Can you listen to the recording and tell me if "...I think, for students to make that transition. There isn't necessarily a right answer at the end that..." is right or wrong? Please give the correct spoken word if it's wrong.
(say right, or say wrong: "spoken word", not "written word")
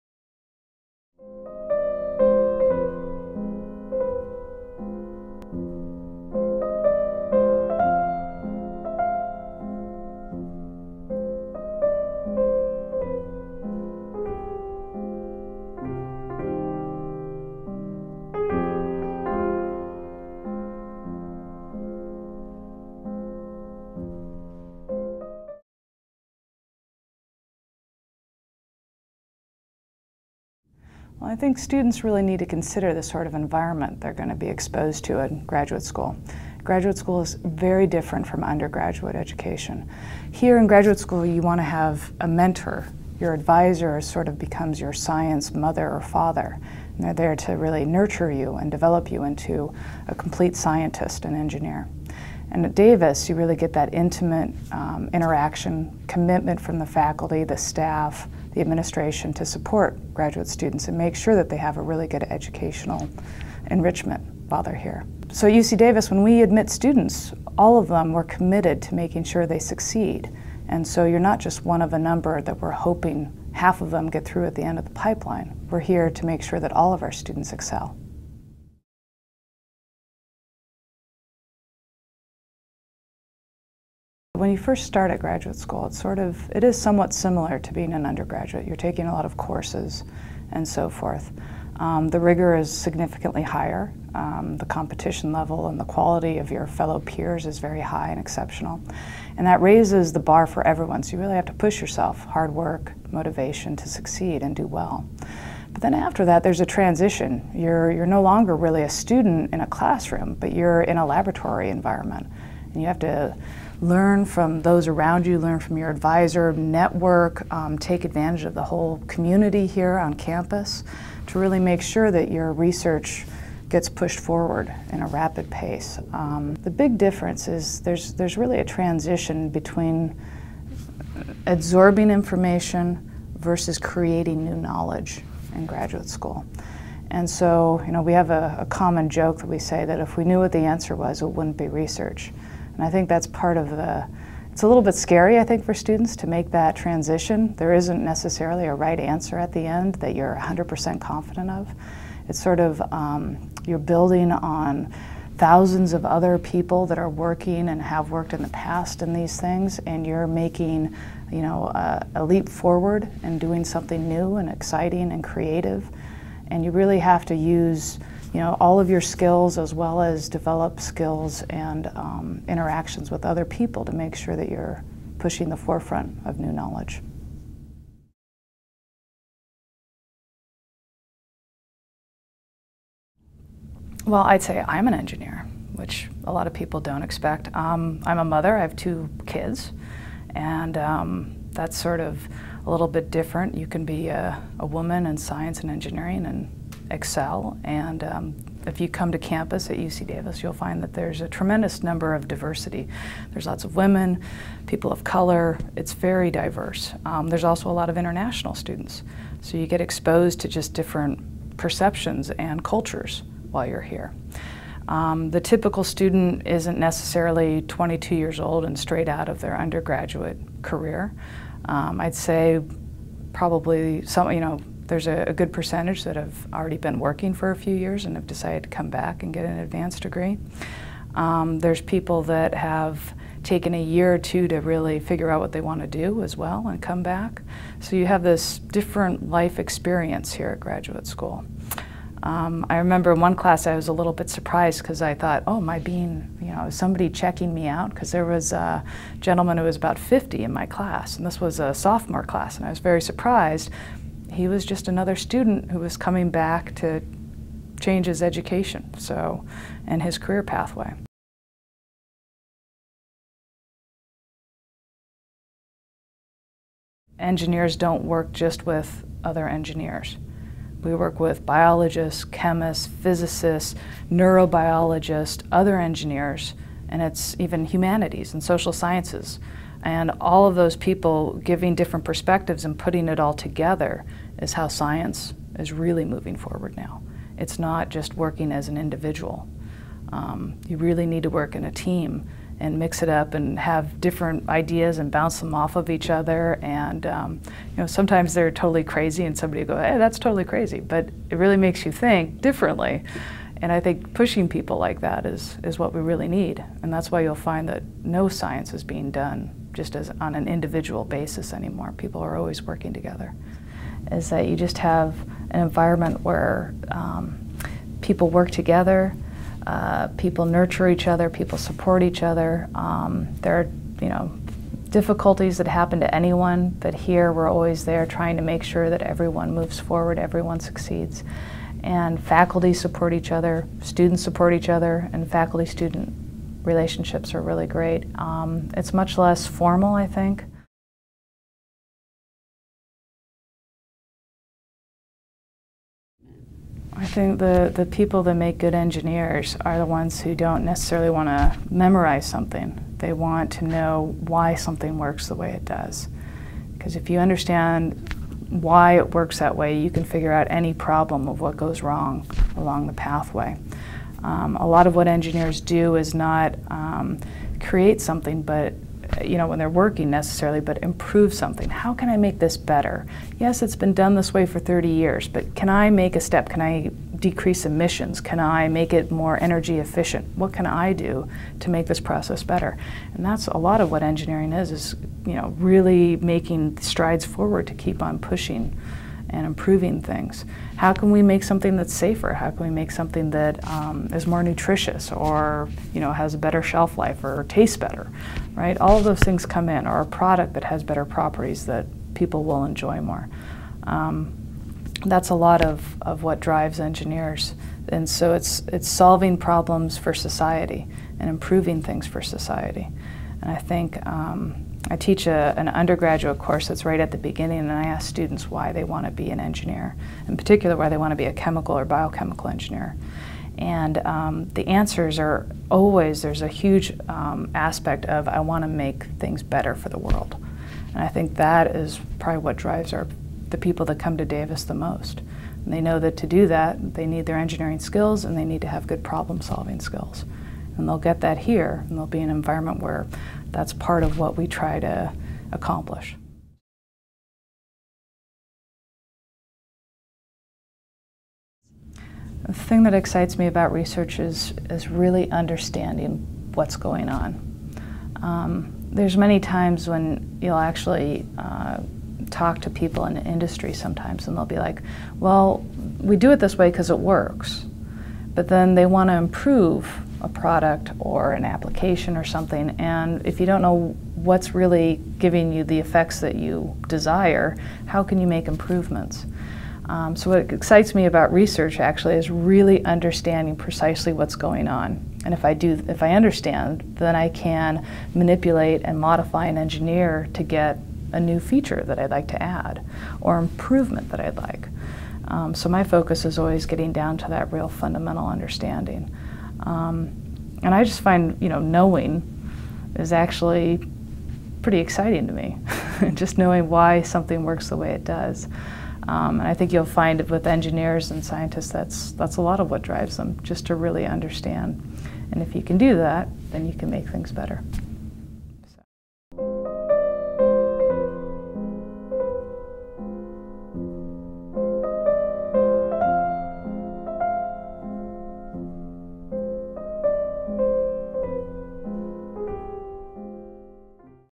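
right.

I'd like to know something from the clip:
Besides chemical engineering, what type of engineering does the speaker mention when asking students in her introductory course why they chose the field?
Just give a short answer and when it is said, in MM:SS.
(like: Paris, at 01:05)
biochemical, at 07:01.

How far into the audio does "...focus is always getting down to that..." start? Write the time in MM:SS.
08:15.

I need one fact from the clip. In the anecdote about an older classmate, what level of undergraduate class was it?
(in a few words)
sophomore.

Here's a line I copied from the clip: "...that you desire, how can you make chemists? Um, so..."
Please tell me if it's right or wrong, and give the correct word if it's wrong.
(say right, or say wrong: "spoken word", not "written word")
wrong: "improvements", not "chemists".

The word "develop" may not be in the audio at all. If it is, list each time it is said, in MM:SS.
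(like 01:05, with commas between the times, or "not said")
00:48, 02:50.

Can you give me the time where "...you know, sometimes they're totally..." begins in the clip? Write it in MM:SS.
04:57.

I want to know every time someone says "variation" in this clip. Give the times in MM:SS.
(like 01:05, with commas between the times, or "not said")
not said.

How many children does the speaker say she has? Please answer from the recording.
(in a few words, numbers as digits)
2.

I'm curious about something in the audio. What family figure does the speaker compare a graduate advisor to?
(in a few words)
science mother or father.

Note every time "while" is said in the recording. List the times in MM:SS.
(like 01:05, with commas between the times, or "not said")
01:04, 03:33.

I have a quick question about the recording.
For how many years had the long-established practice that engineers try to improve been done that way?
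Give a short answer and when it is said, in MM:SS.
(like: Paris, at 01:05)
30, at 06:14.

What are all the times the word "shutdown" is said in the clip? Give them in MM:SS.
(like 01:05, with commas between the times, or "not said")
not said.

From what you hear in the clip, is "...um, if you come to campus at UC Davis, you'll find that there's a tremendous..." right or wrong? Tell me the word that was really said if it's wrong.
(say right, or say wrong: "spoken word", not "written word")
right.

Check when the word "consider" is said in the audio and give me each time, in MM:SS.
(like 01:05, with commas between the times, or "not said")
00:32.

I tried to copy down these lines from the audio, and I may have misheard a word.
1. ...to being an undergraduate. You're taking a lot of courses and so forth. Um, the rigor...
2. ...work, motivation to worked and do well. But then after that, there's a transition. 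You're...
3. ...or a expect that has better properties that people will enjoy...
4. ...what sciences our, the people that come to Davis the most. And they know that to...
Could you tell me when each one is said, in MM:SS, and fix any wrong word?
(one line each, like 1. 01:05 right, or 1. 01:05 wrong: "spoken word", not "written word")
1. 01:27 right
2. 01:42 wrong: "succeed", not "worked"
3. 06:39 wrong: "product", not "expect"
4. 07:12 wrong: "drives", not "sciences".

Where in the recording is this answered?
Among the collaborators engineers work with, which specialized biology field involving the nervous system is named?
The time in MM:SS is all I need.
04:34.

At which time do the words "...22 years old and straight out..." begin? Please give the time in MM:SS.
03:37.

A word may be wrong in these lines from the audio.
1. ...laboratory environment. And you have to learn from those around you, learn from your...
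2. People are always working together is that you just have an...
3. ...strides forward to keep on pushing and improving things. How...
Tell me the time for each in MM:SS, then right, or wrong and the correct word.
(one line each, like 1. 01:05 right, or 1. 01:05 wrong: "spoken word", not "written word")
1. 01:51 right
2. 05:11 right
3. 06:26 right.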